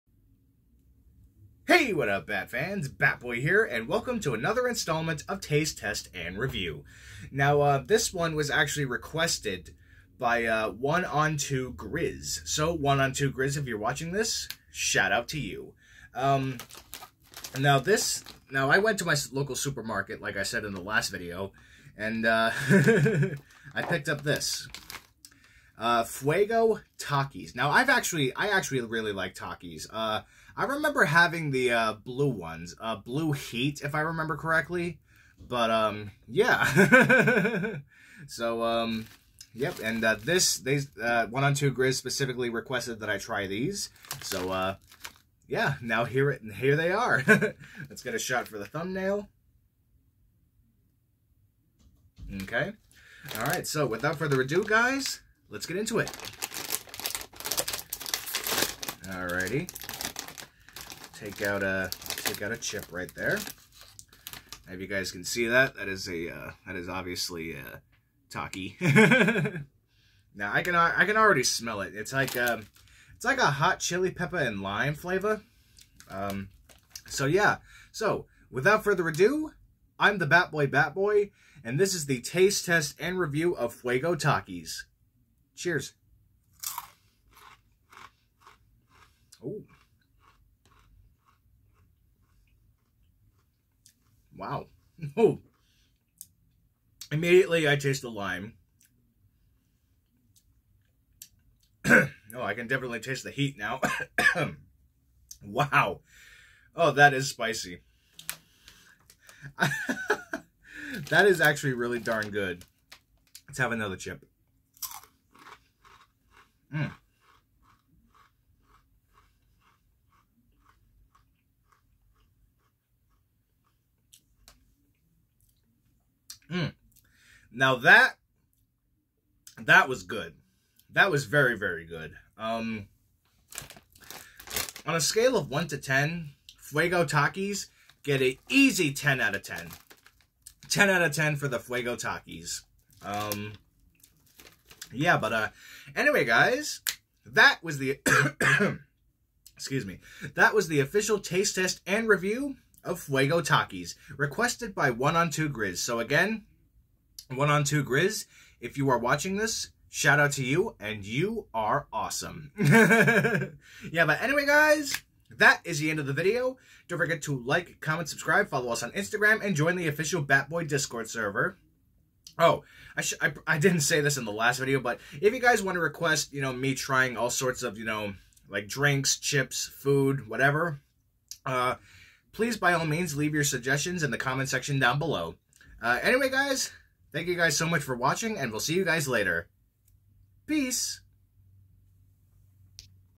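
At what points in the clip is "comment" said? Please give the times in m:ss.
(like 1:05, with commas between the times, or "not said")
2:47, 3:04.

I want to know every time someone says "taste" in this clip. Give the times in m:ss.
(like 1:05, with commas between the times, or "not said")
0:05, 1:22, 1:37, 1:43, 2:31.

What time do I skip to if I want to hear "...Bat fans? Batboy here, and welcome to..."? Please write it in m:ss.
0:02.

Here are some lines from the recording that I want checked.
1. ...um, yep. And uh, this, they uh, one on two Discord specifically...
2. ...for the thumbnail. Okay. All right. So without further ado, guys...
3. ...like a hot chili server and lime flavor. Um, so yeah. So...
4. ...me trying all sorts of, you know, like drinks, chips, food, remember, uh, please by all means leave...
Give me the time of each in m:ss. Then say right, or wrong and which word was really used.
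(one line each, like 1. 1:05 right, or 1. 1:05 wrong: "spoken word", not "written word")
1. 0:38 wrong: "Grizz", not "Discord"
2. 0:48 right
3. 1:13 wrong: "pepper", not "server"
4. 2:56 wrong: "whatever", not "remember".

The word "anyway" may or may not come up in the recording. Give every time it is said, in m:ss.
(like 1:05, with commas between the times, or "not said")
2:25, 2:44, 3:06.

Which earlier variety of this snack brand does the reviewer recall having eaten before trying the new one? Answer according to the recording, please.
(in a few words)
Blue Heat.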